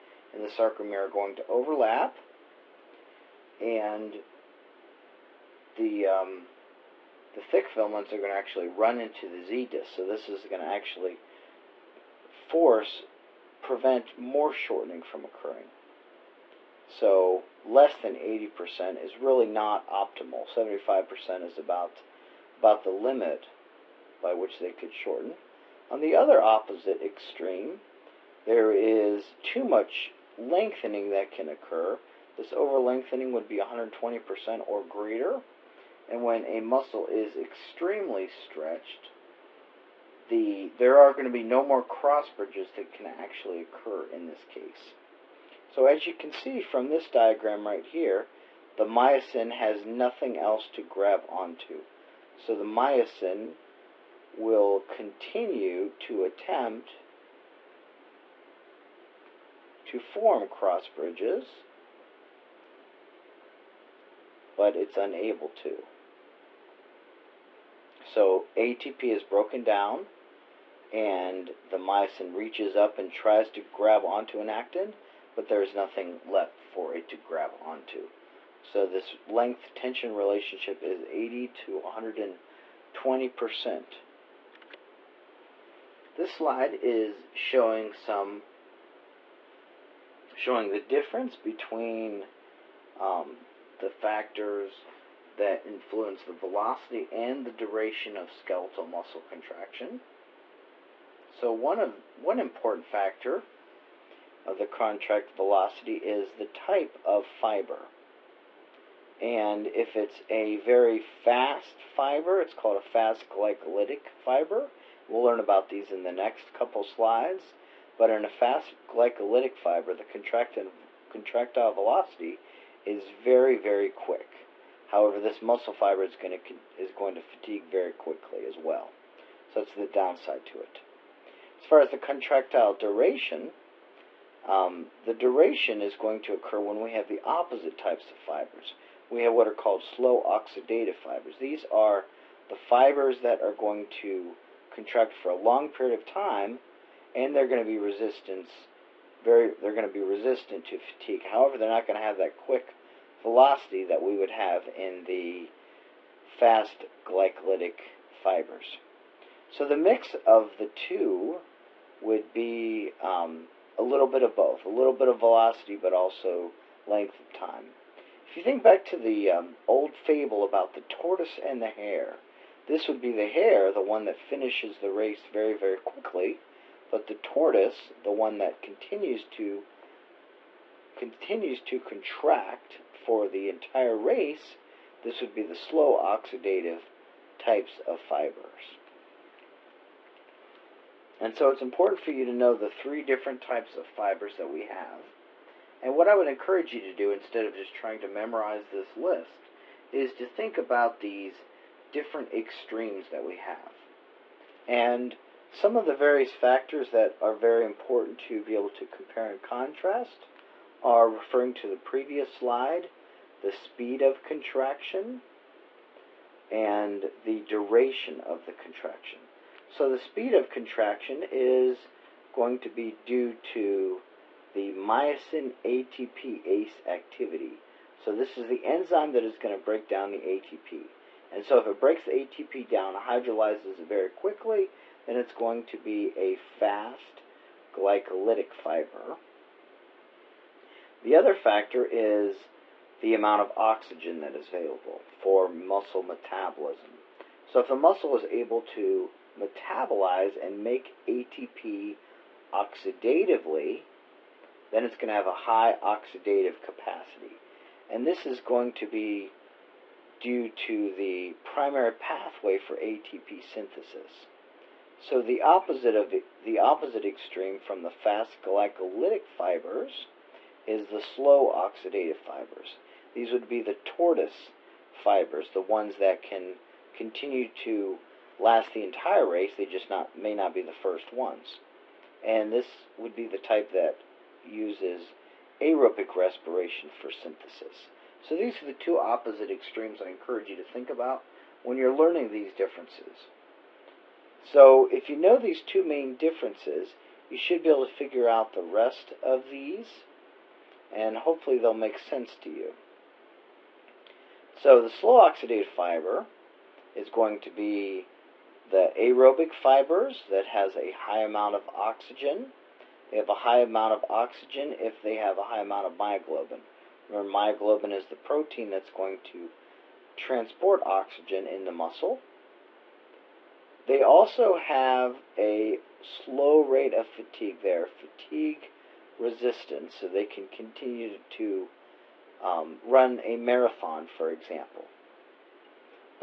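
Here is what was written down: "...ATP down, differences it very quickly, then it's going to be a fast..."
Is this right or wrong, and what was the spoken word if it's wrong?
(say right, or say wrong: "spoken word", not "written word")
wrong: "hydrolyzes", not "differences".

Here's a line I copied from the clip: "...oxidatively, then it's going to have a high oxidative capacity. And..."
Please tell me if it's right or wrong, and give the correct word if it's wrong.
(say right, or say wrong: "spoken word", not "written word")
right.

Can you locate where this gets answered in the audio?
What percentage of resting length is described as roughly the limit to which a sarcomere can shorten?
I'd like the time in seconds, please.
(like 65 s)
20 s.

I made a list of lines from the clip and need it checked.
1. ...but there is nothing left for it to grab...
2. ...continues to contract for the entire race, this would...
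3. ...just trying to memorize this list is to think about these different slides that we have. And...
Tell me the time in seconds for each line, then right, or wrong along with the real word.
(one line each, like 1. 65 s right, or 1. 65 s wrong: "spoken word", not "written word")
1. 75 s right
2. 180 s right
3. 197 s wrong: "extremes", not "slides".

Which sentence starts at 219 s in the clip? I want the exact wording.
So the speed of contraction is going to be due to the myosin ATPase activity.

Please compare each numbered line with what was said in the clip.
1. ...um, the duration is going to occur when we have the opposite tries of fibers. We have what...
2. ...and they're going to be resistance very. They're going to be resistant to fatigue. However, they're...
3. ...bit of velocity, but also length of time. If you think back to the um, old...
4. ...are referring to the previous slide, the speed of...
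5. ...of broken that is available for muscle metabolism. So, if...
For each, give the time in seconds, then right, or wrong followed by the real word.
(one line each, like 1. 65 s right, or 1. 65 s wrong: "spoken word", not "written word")
1. 134 s wrong: "types", not "tries"
2. 147 s right
3. 164 s right
4. 210 s right
5. 243 s wrong: "oxygen", not "broken".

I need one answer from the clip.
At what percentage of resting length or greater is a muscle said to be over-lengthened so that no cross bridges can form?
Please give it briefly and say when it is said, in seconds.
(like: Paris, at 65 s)
120%, at 33 s.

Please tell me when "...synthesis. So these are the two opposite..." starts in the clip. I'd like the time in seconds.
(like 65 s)
287 s.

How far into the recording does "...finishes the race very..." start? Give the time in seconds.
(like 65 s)
174 s.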